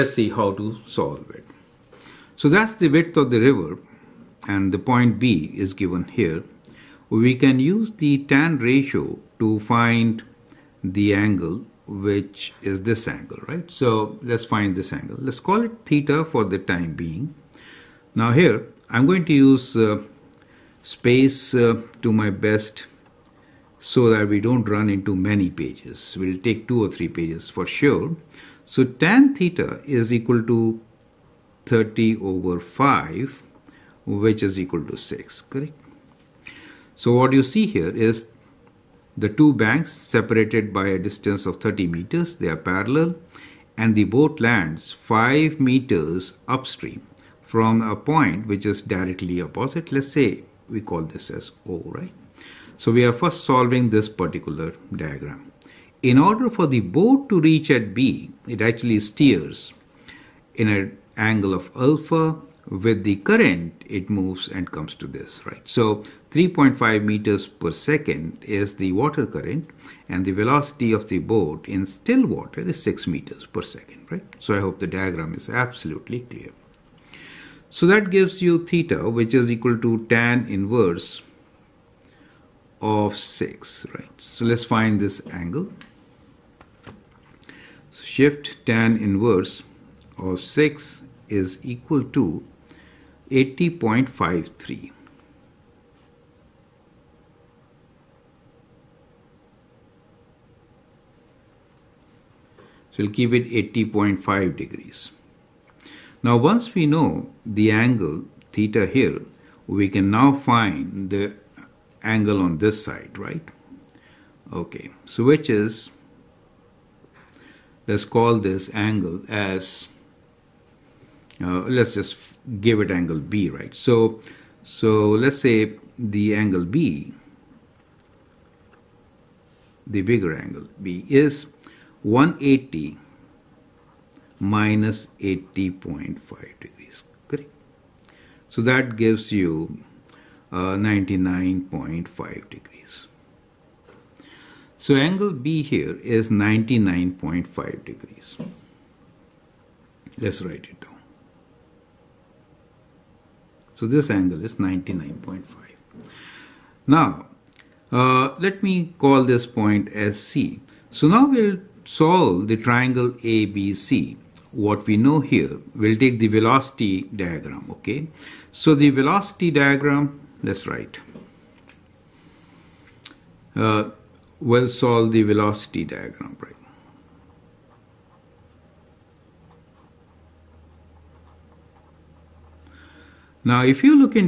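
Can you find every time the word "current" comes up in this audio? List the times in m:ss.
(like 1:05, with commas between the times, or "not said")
1:03, 1:09.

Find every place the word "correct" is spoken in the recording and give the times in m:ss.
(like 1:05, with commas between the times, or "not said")
0:35, 2:17.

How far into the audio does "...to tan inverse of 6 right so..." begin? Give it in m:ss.
1:19.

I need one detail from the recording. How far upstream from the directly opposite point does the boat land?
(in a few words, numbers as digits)
5 meters.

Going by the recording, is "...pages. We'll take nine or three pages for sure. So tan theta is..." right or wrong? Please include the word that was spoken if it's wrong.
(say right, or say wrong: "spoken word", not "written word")
wrong: "two", not "nine".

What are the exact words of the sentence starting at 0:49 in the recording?
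Let's say we call this as O, right?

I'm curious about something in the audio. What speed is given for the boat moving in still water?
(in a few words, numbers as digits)
6 meters per second.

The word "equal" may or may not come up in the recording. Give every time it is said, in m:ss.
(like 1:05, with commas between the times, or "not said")
0:30, 0:34, 1:19, 1:31.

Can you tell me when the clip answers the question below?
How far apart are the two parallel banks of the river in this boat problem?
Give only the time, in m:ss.
0:41.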